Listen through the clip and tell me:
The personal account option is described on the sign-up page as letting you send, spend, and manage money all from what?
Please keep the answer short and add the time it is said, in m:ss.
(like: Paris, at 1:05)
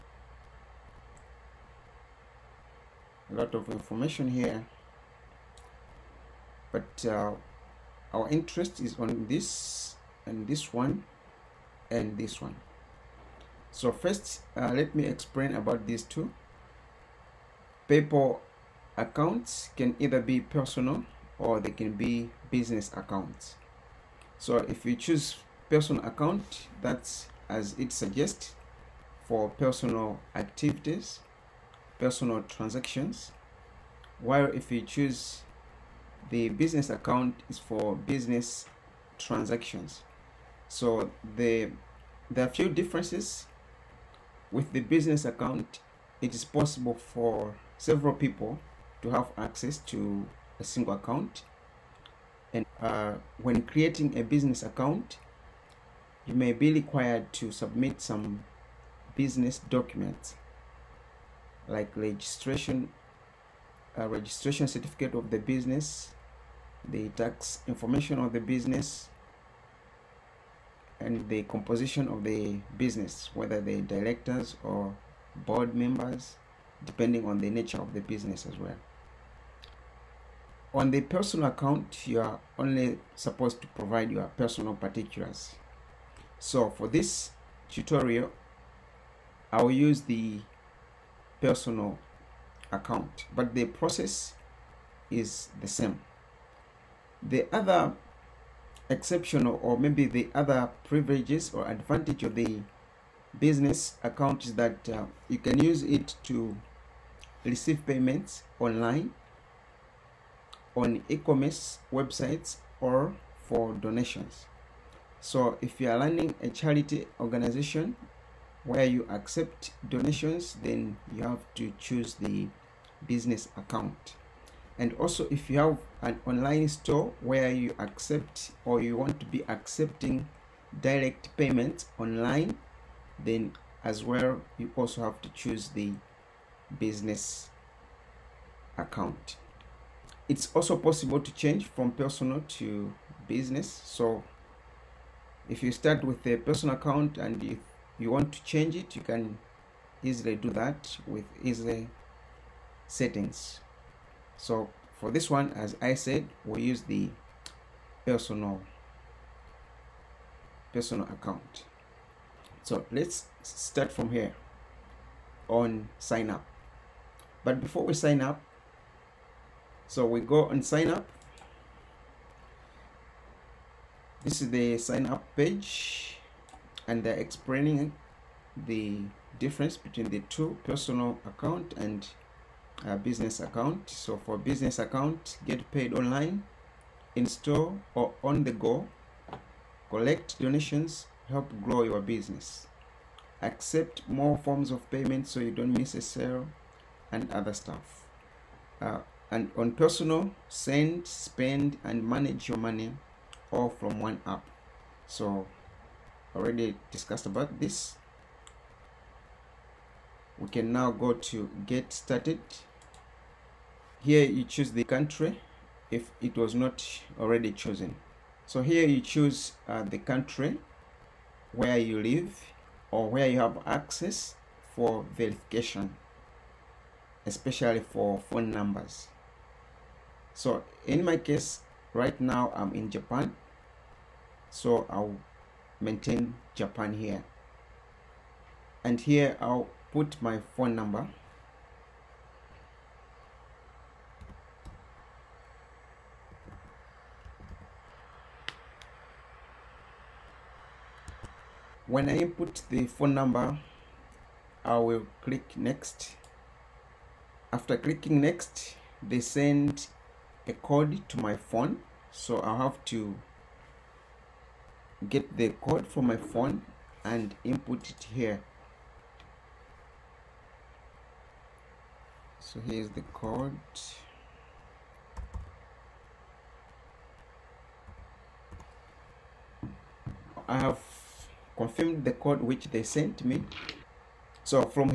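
One app, at 3:23.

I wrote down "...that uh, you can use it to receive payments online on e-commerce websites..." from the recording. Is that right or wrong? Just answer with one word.
right.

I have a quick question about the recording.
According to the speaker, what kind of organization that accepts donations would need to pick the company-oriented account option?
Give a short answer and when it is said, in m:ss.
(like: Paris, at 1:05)
Charity organization, at 1:56.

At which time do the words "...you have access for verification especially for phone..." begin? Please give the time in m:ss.
3:43.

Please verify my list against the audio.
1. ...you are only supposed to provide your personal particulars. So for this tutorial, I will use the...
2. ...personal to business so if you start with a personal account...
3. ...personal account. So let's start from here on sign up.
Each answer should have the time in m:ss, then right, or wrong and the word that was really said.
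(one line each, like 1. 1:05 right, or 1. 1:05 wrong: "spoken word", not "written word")
1. 1:22 right
2. 2:21 right
3. 2:40 right.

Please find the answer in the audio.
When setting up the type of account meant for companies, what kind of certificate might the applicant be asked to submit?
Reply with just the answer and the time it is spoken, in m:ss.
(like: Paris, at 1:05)
Registration certificate, at 1:04.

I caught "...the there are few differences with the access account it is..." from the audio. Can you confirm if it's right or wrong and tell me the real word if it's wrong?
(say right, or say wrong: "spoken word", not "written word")
wrong: "business", not "access".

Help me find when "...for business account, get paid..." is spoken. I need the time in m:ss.
3:04.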